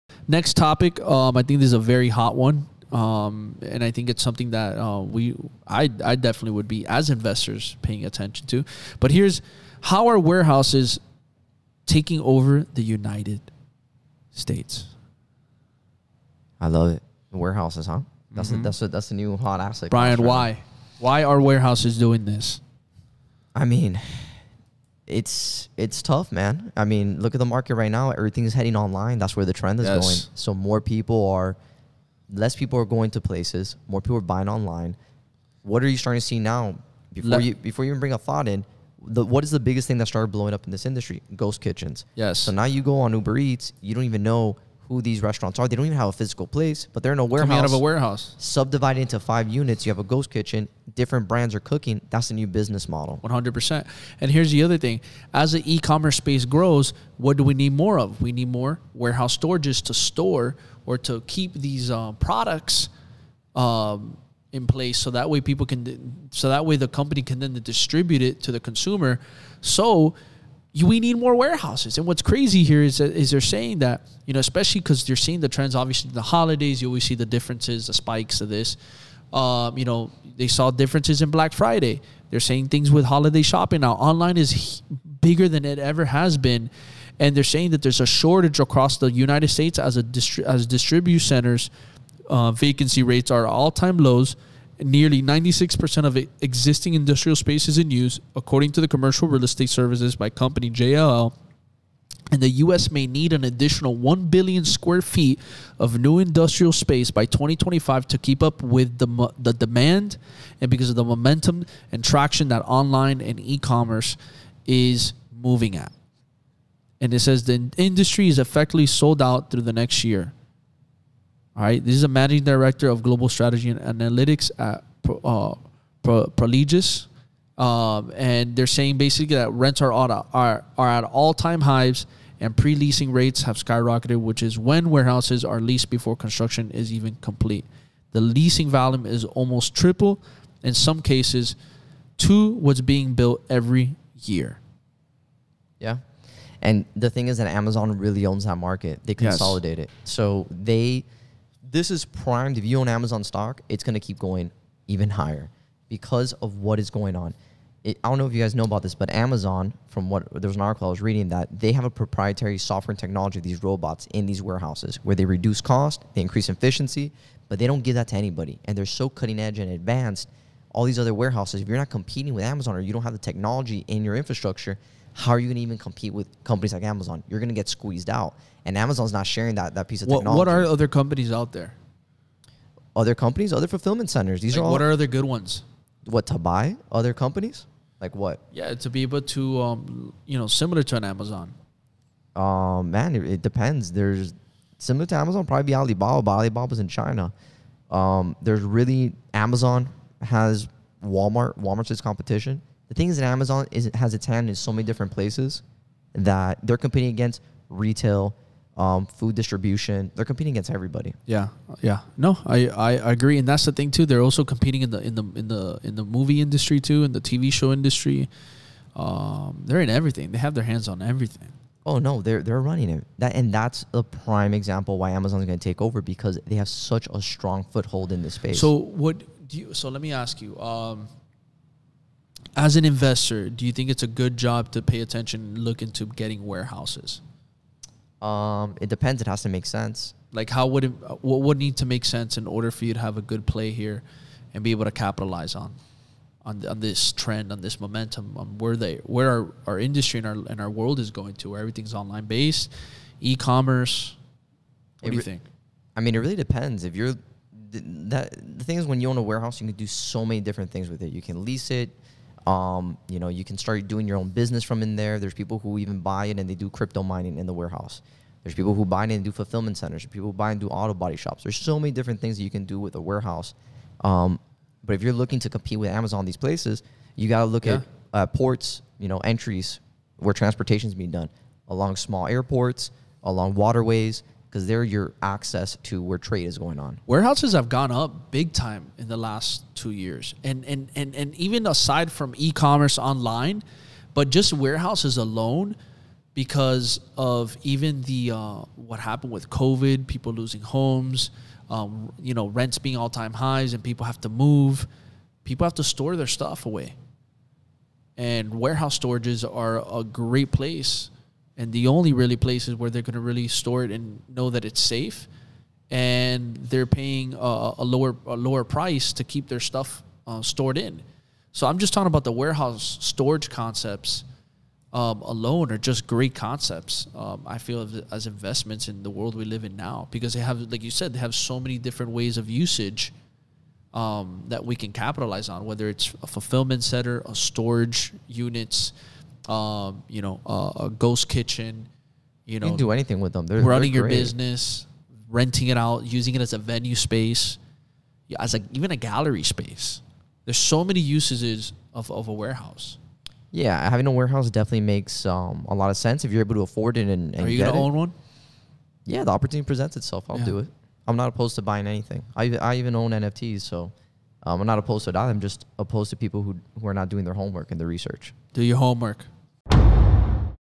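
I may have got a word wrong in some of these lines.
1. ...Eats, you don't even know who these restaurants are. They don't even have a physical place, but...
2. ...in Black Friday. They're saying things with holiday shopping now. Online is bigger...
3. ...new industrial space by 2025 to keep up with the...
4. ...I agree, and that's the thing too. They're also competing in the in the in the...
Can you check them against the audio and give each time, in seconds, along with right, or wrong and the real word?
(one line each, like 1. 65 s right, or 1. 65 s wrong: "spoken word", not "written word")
1. 43 s right
2. 81 s right
3. 105 s right
4. 212 s right.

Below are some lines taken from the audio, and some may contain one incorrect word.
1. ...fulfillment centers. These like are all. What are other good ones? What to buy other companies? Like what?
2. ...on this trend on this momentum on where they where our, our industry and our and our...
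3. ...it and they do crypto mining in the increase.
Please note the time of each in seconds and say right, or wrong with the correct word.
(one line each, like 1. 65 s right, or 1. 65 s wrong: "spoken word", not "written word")
1. 183 s right
2. 246 s right
3. 266 s wrong: "warehouse", not "increase".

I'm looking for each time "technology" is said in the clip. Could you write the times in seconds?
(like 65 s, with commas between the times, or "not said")
162 s, 173 s, 180 s.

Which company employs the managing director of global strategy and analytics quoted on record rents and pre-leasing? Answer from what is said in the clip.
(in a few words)
Prologis.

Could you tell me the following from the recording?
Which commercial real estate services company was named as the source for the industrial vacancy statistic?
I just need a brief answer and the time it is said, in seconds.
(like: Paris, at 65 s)
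JLL, at 100 s.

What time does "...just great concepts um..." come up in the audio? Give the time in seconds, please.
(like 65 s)
325 s.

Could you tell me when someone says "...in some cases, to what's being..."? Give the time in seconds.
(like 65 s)
140 s.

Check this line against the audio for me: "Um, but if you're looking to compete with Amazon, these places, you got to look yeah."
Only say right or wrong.
right.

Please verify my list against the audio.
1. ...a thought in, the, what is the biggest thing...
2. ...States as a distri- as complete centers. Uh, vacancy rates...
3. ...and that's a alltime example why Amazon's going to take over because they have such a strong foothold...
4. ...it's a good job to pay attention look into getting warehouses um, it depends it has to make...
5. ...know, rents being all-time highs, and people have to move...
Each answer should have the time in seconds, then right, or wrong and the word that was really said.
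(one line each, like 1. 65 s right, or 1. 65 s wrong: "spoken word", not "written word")
1. 38 s right
2. 89 s wrong: "distribute", not "complete"
3. 223 s wrong: "prime", not "alltime"
4. 233 s right
5. 302 s right.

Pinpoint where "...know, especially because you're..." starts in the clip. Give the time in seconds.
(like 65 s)
74 s.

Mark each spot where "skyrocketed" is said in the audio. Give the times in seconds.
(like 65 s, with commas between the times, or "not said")
133 s.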